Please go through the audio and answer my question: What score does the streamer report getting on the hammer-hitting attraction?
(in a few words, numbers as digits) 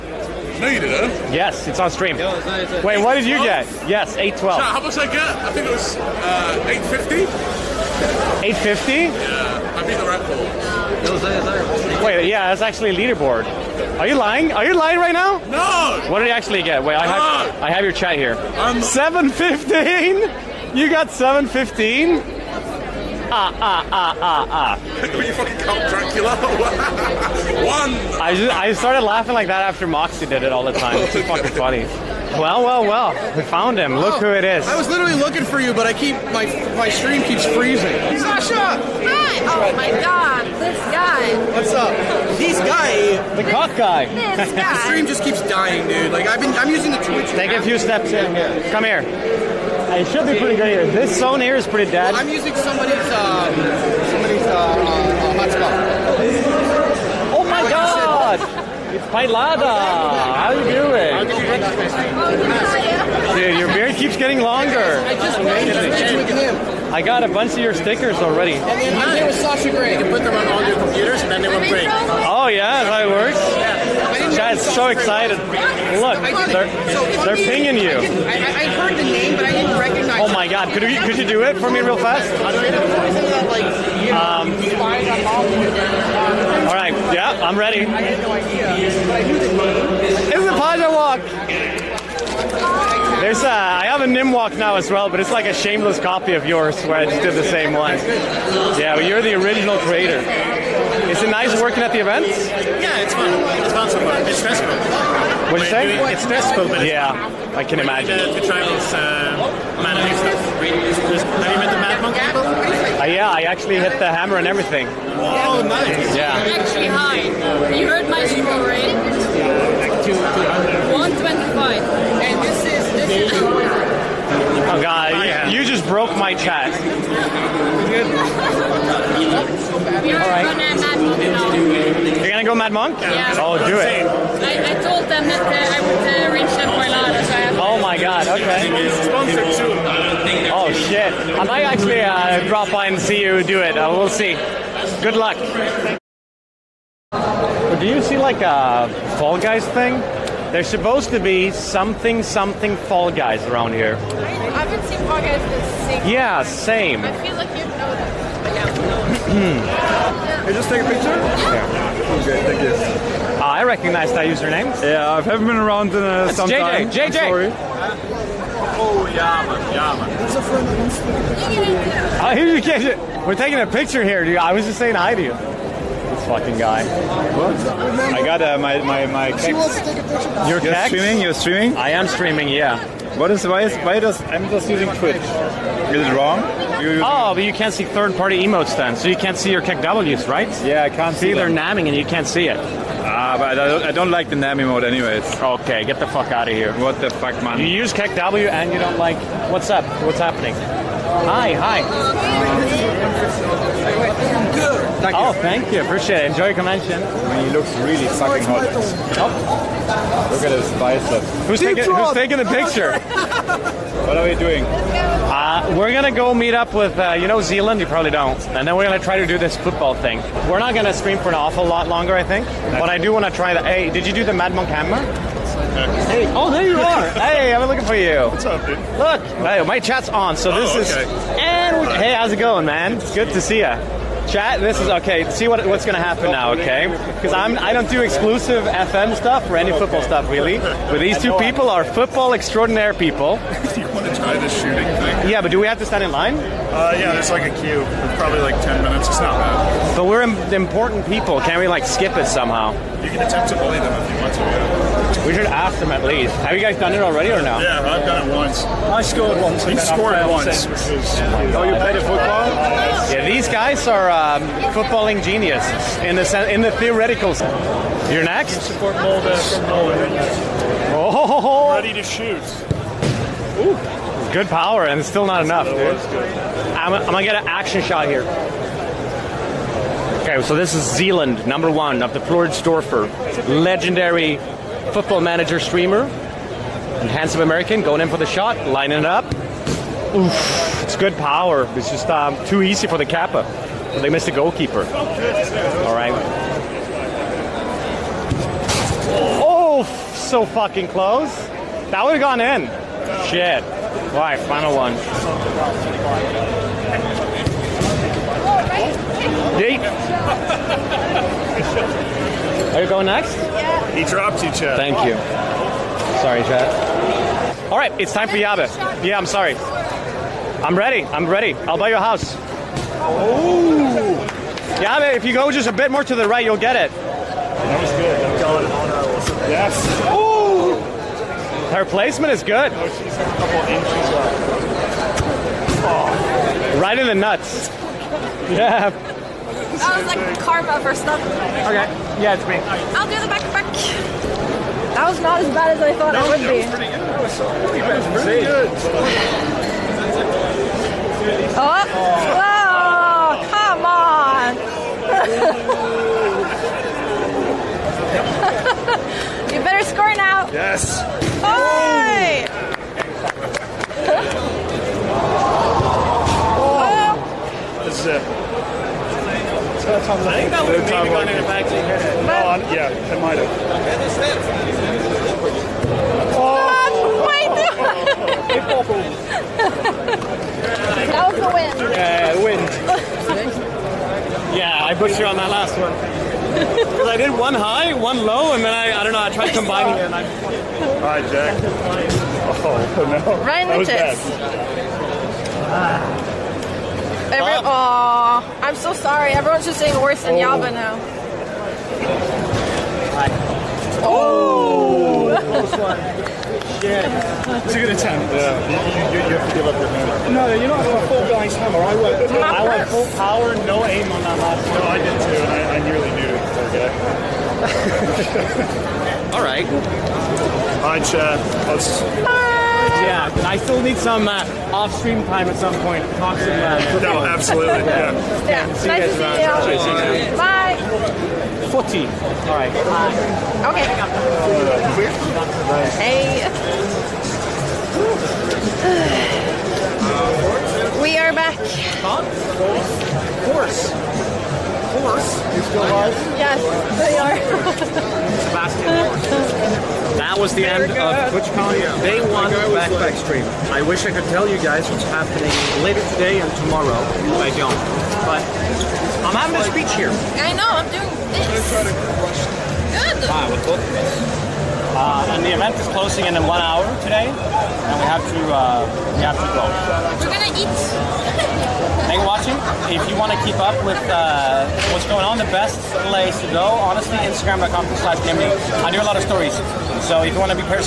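125.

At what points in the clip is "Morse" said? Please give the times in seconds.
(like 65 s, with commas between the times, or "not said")
445 s.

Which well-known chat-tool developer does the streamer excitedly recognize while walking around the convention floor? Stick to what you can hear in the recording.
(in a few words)
Pajlada.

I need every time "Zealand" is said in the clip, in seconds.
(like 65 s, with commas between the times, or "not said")
217 s, 280 s.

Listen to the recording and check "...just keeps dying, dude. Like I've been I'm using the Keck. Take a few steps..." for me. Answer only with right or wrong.
wrong.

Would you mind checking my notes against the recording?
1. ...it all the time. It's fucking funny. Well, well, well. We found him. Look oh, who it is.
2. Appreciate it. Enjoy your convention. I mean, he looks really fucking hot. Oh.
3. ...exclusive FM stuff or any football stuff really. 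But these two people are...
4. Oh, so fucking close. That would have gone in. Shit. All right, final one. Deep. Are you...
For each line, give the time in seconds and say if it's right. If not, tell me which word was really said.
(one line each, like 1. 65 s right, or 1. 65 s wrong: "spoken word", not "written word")
1. 30 s right
2. 205 s right
3. 238 s right
4. 299 s right.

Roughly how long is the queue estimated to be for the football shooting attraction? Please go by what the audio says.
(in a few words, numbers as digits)
10 minutes.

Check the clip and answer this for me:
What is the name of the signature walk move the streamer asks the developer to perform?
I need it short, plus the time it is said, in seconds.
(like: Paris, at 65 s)
Paja Walk, at 90 s.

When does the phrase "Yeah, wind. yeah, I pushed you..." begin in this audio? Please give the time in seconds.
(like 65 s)
381 s.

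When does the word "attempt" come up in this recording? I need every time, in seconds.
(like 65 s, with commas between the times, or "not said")
253 s, 407 s.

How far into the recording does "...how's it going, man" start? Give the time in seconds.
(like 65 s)
232 s.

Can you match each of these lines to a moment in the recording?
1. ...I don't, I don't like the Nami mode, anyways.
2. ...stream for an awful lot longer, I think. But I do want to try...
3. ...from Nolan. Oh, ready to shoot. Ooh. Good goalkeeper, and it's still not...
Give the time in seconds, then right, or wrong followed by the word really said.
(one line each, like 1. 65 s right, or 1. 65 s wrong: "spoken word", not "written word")
1. 193 s right
2. 220 s right
3. 269 s wrong: "power", not "goalkeeper".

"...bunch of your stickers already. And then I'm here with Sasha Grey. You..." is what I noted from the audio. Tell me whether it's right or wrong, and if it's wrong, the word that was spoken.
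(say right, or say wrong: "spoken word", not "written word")
right.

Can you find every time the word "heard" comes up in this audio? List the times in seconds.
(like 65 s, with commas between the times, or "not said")
78 s, 117 s.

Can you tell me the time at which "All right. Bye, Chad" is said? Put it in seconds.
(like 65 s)
419 s.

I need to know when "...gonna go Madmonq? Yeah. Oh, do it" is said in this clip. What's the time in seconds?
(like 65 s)
132 s.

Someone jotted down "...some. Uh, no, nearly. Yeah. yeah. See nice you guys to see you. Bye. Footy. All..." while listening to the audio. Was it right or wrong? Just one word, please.
wrong.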